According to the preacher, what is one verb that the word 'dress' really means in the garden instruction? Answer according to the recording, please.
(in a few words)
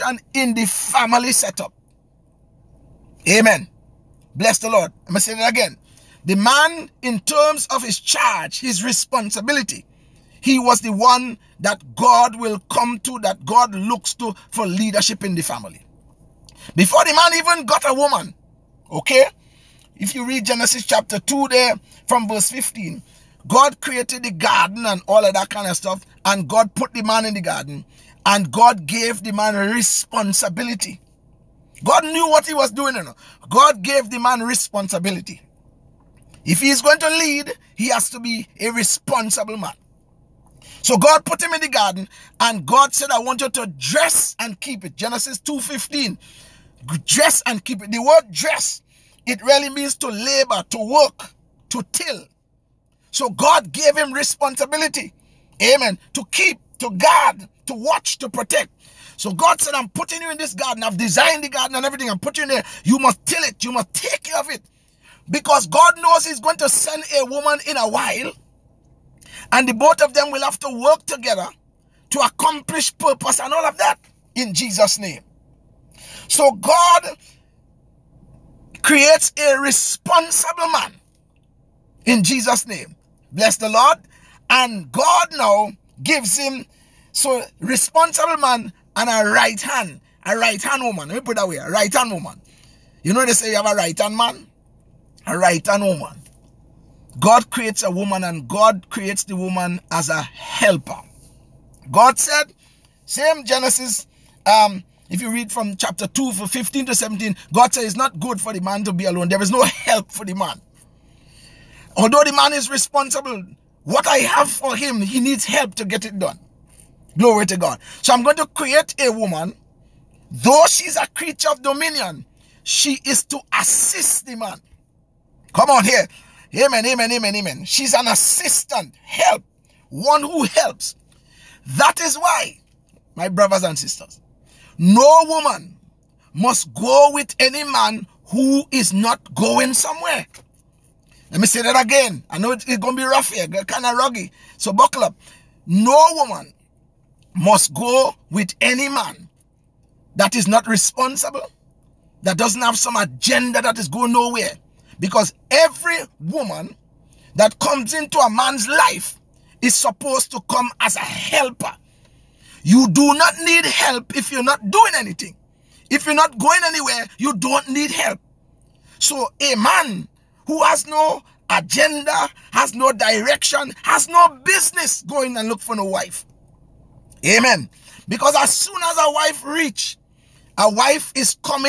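to till.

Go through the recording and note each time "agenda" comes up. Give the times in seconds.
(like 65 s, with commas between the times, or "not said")
152 s, 171 s.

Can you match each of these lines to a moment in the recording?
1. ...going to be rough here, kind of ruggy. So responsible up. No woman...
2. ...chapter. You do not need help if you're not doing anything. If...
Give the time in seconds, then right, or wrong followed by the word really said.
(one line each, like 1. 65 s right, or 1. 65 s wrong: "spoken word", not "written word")
1. 142 s wrong: "buckle", not "responsible"
2. 160 s wrong: "helper", not "chapter".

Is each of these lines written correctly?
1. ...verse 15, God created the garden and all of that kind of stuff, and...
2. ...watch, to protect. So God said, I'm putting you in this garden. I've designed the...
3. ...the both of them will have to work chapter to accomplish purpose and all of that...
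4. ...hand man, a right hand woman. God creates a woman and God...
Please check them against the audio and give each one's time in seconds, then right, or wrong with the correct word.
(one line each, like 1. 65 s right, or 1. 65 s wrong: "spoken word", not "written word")
1. 22 s right
2. 57 s right
3. 69 s wrong: "together", not "chapter"
4. 93 s right.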